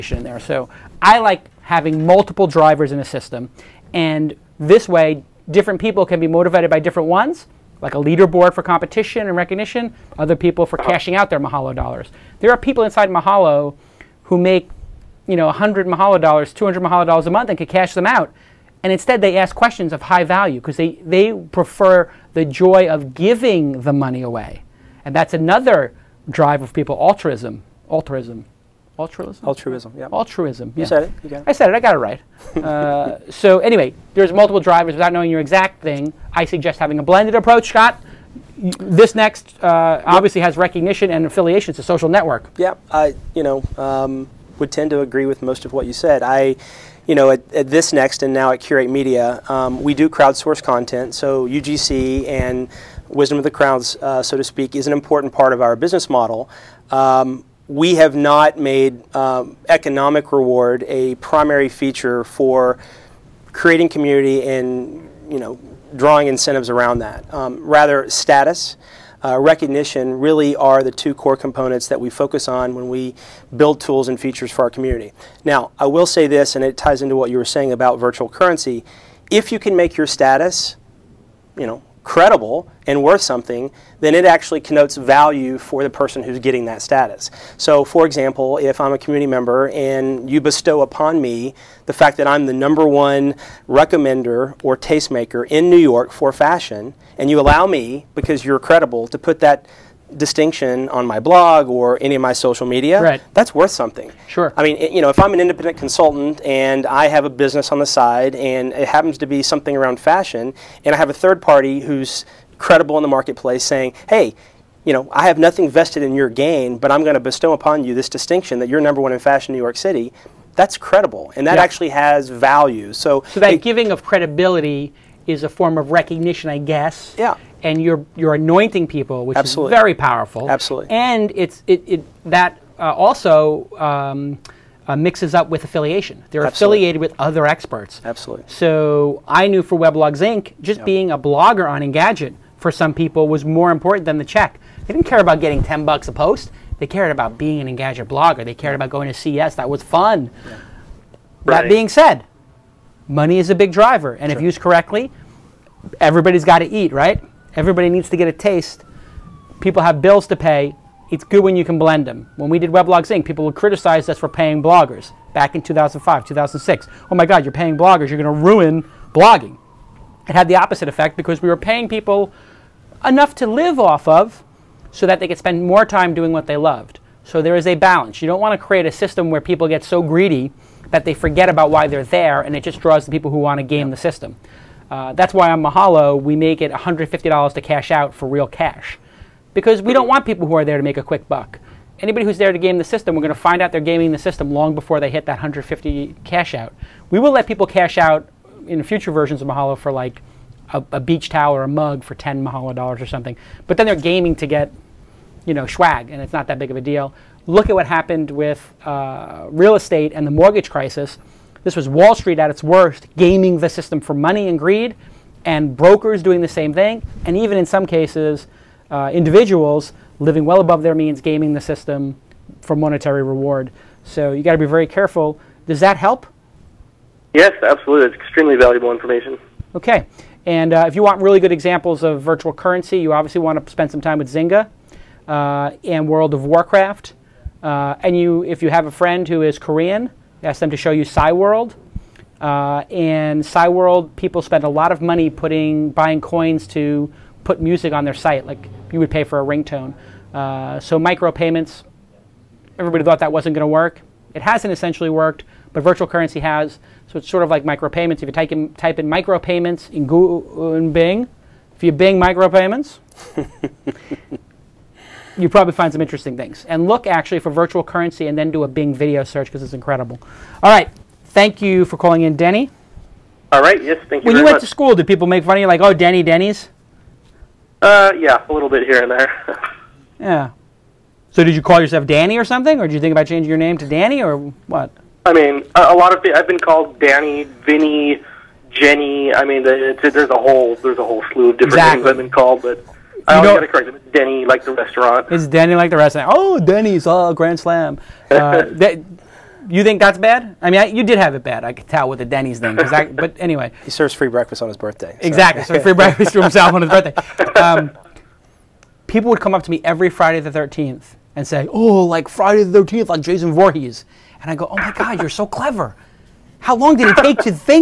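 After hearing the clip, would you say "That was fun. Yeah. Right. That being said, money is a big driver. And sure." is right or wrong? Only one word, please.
right.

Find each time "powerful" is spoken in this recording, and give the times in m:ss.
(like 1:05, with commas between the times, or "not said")
2:09.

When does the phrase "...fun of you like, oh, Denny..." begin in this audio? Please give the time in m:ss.
4:35.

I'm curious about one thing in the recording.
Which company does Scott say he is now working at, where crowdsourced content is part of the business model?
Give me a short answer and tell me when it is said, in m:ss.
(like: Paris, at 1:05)
Curate Media, at 0:48.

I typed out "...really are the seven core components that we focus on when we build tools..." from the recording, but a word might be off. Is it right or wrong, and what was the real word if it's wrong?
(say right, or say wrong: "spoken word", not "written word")
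wrong: "two", not "seven".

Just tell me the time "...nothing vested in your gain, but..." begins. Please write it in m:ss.
1:55.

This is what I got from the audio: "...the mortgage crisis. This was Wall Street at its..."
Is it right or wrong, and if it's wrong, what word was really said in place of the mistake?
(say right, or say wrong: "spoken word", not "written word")
right.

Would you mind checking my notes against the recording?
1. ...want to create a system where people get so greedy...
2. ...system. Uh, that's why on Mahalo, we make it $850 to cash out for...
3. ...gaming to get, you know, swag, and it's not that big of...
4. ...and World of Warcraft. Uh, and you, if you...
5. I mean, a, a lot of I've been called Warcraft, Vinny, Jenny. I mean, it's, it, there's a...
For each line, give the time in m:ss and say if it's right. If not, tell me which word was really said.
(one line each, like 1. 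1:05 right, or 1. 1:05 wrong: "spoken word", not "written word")
1. 2:58 right
2. 3:03 wrong: "150", not "850"
3. 3:23 right
4. 3:55 right
5. 4:45 wrong: "Danny", not "Warcraft".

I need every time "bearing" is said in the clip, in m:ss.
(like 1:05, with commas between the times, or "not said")
not said.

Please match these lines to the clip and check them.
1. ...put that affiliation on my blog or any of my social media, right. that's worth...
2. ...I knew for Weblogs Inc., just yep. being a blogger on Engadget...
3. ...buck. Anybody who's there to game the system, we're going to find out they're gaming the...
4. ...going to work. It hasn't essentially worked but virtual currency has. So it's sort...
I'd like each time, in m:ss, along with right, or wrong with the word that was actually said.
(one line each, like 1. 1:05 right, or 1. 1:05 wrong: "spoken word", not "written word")
1. 1:39 wrong: "distinction", not "affiliation"
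2. 2:19 right
3. 3:11 right
4. 4:13 right.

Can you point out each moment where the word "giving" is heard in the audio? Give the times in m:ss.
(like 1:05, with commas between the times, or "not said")
0:23, 2:03.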